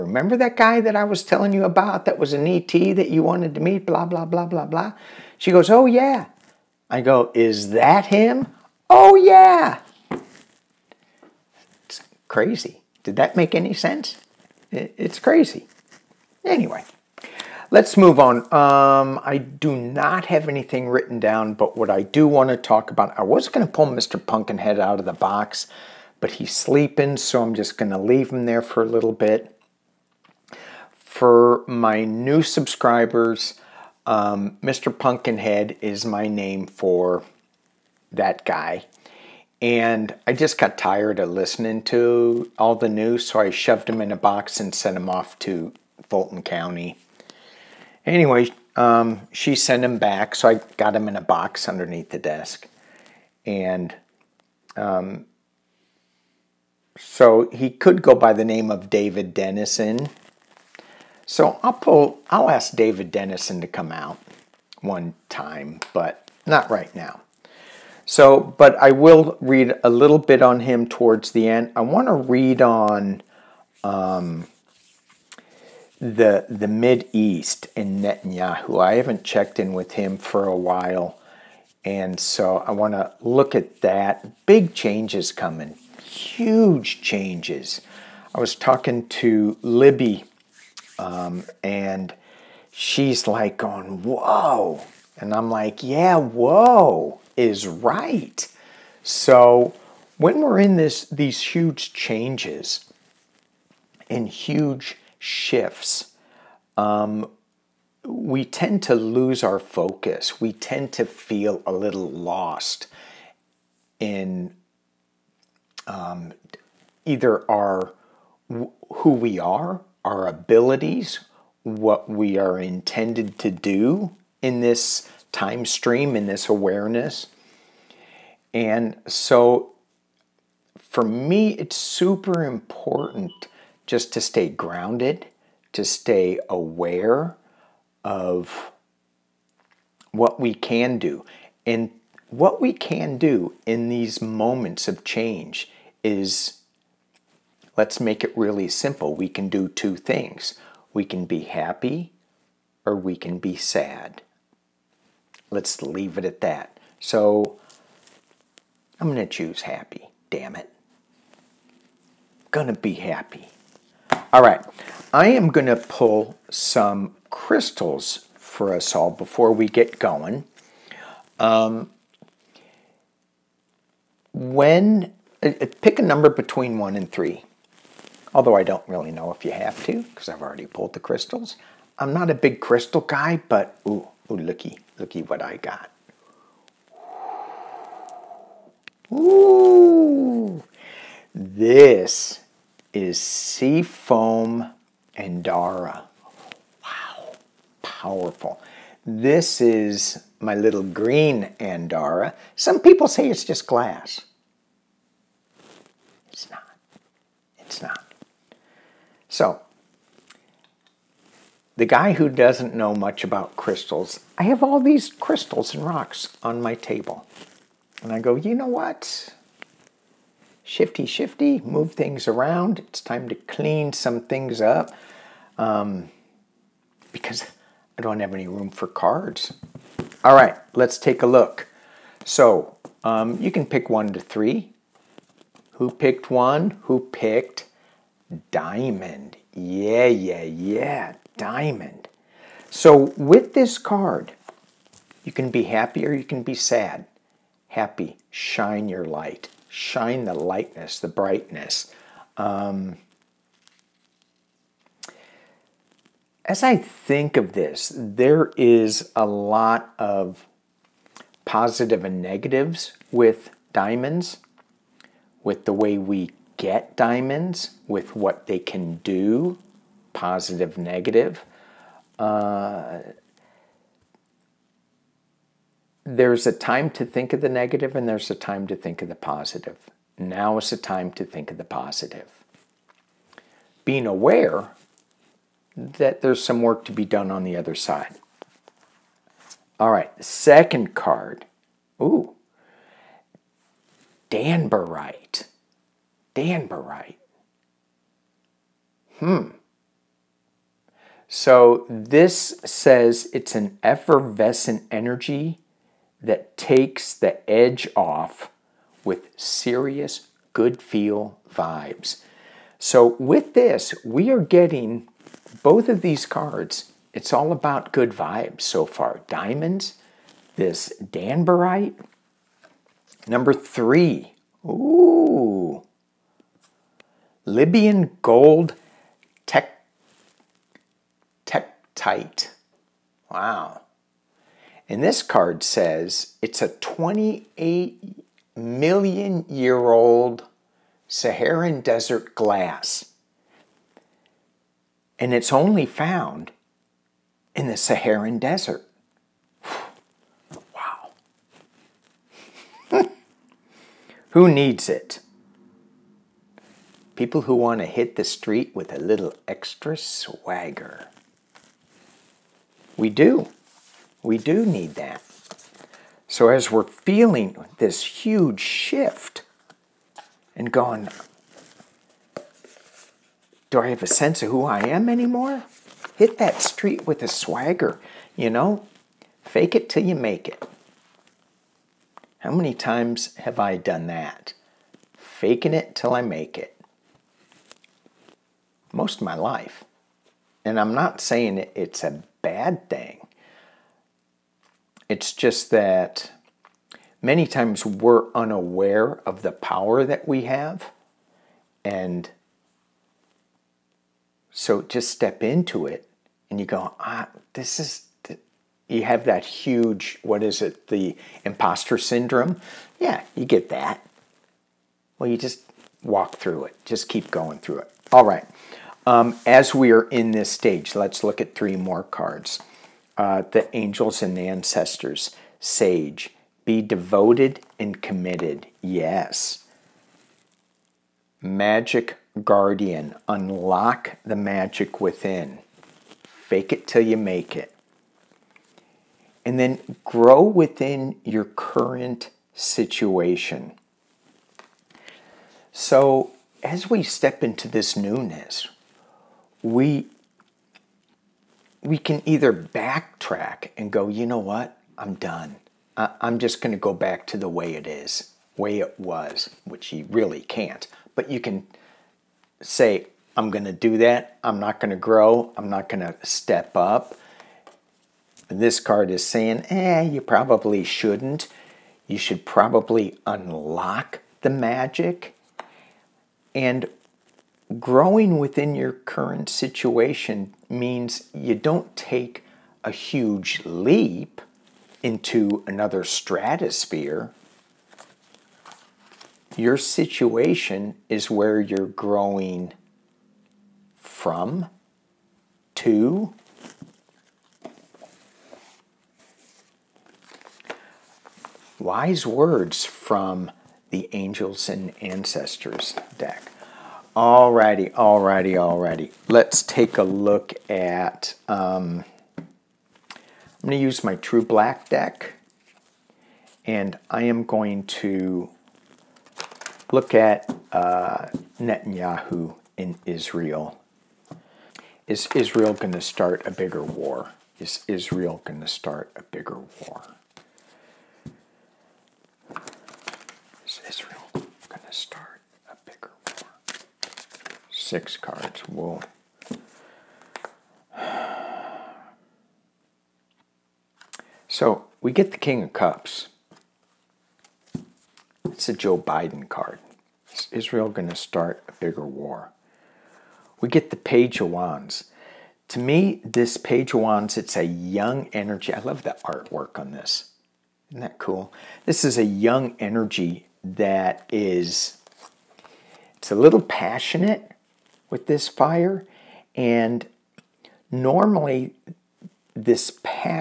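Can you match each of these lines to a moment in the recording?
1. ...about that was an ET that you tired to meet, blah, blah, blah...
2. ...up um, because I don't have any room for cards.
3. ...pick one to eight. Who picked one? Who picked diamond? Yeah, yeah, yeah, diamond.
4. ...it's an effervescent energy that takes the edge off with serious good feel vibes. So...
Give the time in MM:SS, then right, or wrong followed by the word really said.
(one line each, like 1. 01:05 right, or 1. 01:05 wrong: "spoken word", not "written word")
1. 00:01 wrong: "wanted", not "tired"
2. 03:44 right
3. 03:53 wrong: "three", not "eight"
4. 05:03 right.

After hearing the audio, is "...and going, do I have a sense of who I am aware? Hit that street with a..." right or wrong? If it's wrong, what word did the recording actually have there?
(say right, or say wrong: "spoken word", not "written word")
wrong: "anymore", not "aware".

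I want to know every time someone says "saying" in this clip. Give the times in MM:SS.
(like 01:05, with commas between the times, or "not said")
06:31, 07:49.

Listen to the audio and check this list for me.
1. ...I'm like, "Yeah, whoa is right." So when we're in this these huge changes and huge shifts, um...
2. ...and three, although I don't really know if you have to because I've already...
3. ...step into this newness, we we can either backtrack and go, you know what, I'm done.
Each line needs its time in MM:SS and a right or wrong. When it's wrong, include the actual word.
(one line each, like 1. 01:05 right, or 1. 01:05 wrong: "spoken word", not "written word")
1. 01:35 right
2. 02:56 right
3. 07:27 right.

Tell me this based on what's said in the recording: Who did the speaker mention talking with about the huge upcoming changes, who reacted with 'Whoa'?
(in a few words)
Libby.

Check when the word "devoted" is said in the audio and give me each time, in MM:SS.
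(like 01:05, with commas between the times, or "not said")
07:06.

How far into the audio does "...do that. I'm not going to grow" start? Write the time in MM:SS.
07:43.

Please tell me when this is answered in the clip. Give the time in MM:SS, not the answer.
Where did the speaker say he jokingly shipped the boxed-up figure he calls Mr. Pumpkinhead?
00:46.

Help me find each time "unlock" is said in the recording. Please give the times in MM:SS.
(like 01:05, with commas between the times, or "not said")
07:13, 07:53.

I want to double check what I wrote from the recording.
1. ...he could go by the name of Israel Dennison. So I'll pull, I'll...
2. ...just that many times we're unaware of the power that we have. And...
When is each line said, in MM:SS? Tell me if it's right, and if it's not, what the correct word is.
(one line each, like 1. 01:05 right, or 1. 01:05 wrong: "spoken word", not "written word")
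1. 00:57 wrong: "David", not "Israel"
2. 06:35 right.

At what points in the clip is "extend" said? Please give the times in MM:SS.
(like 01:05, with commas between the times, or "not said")
not said.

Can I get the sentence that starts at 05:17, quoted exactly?
It's all about good vibes so far.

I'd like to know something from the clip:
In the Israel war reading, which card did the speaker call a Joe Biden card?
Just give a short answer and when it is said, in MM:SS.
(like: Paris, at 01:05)
King of Cups, at 09:05.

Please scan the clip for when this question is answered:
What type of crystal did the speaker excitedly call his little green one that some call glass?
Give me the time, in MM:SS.
03:13.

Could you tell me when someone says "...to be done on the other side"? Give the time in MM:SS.
04:46.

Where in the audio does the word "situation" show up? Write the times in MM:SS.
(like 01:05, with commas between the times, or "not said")
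07:22, 07:59, 08:09.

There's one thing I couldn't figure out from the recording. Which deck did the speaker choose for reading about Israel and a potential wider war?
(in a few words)
True Black deck.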